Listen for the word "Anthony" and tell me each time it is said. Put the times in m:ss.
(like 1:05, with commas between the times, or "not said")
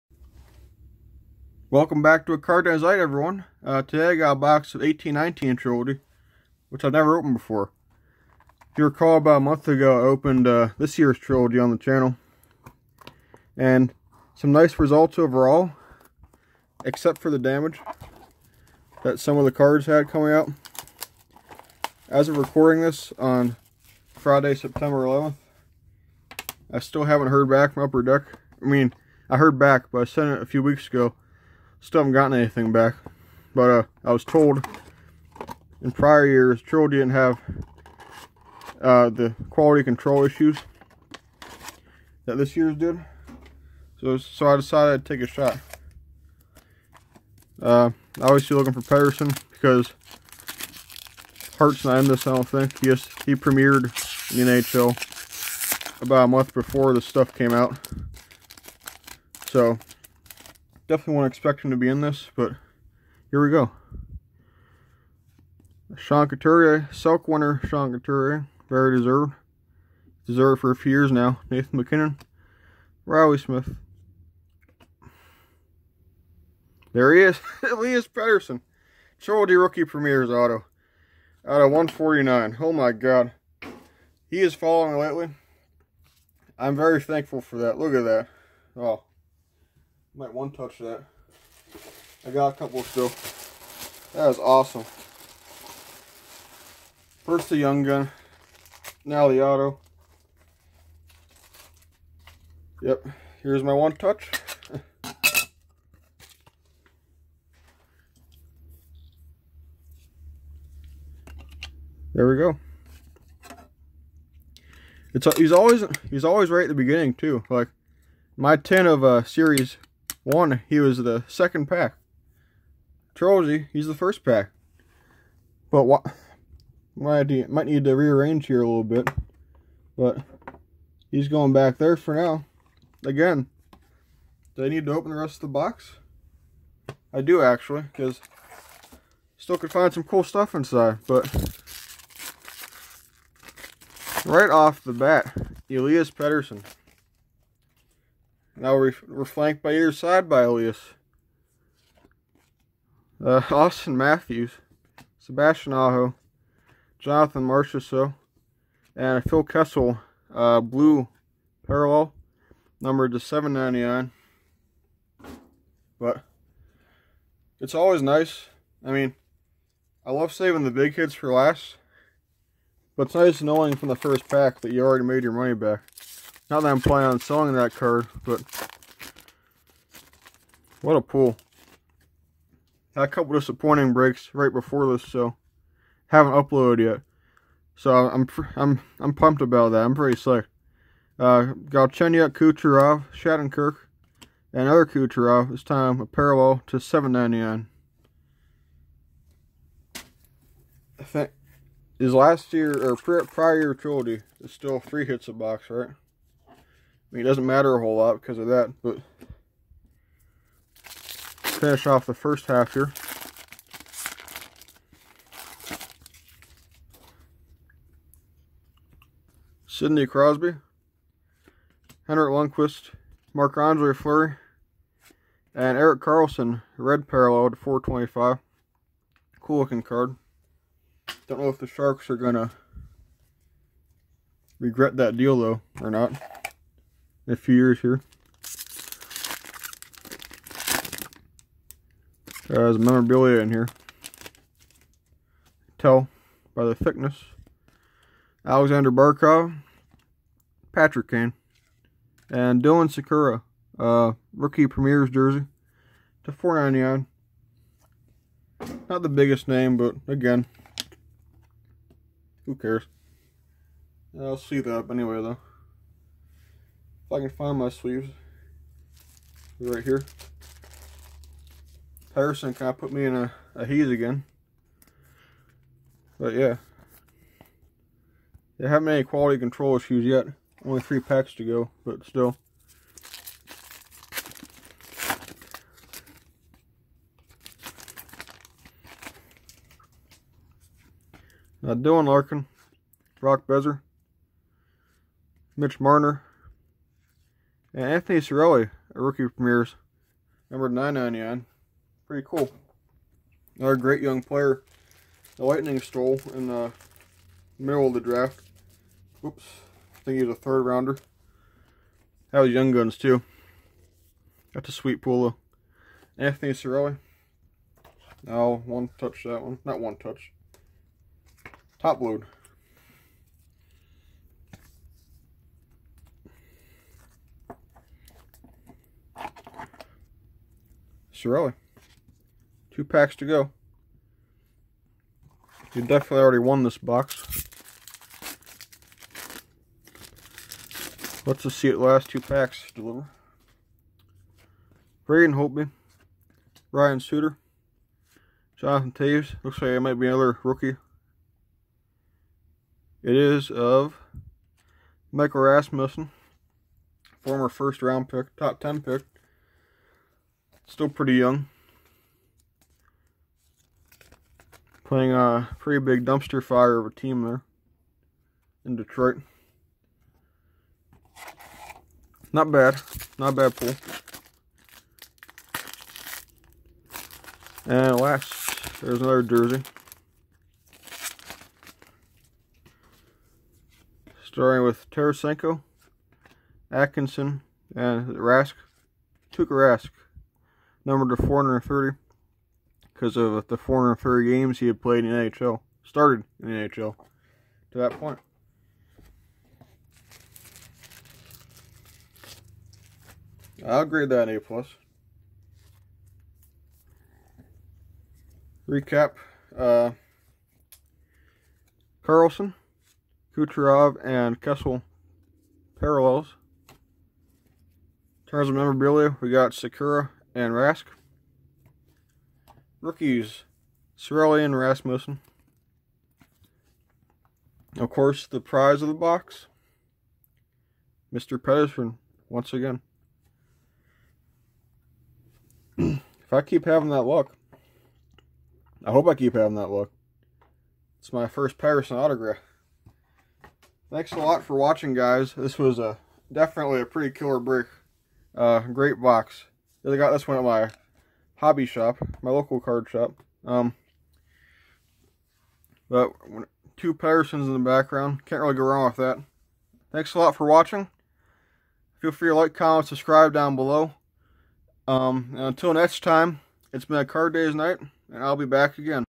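4:57, 5:16.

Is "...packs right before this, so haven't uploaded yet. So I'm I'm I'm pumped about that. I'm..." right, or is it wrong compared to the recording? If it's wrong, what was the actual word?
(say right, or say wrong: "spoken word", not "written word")
wrong: "breaks", not "packs".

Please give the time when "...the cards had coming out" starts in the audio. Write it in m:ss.
0:19.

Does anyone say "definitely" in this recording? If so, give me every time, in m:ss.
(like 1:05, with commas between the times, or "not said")
1:00, 5:35, 7:26.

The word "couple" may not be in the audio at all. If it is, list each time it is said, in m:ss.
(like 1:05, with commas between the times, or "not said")
1:32, 3:03.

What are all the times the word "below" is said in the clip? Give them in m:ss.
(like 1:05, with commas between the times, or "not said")
7:43.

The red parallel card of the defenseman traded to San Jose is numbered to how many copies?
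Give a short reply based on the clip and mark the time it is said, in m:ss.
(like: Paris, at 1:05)
425, at 3:47.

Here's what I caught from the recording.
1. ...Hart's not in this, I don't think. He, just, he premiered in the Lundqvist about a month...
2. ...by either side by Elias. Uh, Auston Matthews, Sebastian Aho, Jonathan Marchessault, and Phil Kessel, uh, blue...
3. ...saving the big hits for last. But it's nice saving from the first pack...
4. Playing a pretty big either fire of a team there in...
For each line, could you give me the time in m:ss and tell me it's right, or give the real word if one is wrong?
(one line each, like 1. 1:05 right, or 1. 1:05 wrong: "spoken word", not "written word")
1. 0:51 wrong: "NHL", not "Lundqvist"
2. 2:29 right
3. 2:50 wrong: "knowing", not "saving"
4. 6:04 wrong: "dumpster", not "either".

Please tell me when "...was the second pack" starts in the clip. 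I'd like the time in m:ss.
2:00.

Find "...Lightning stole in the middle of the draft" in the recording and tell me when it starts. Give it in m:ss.
5:05.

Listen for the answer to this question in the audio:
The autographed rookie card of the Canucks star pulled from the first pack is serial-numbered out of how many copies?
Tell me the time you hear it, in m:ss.
1:21.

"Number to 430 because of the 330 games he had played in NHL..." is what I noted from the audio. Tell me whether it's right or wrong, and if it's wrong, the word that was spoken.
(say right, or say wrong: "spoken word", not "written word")
wrong: "430", not "330".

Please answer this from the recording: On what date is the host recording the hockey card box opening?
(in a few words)
Friday, September 11th.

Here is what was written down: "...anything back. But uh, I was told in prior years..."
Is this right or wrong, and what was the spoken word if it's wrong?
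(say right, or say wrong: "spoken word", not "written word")
right.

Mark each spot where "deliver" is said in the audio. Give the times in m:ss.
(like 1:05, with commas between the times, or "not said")
5:42.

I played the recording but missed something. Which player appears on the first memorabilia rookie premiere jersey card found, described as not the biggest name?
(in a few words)
Dylan Sikura.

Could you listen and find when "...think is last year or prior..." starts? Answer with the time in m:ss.
3:21.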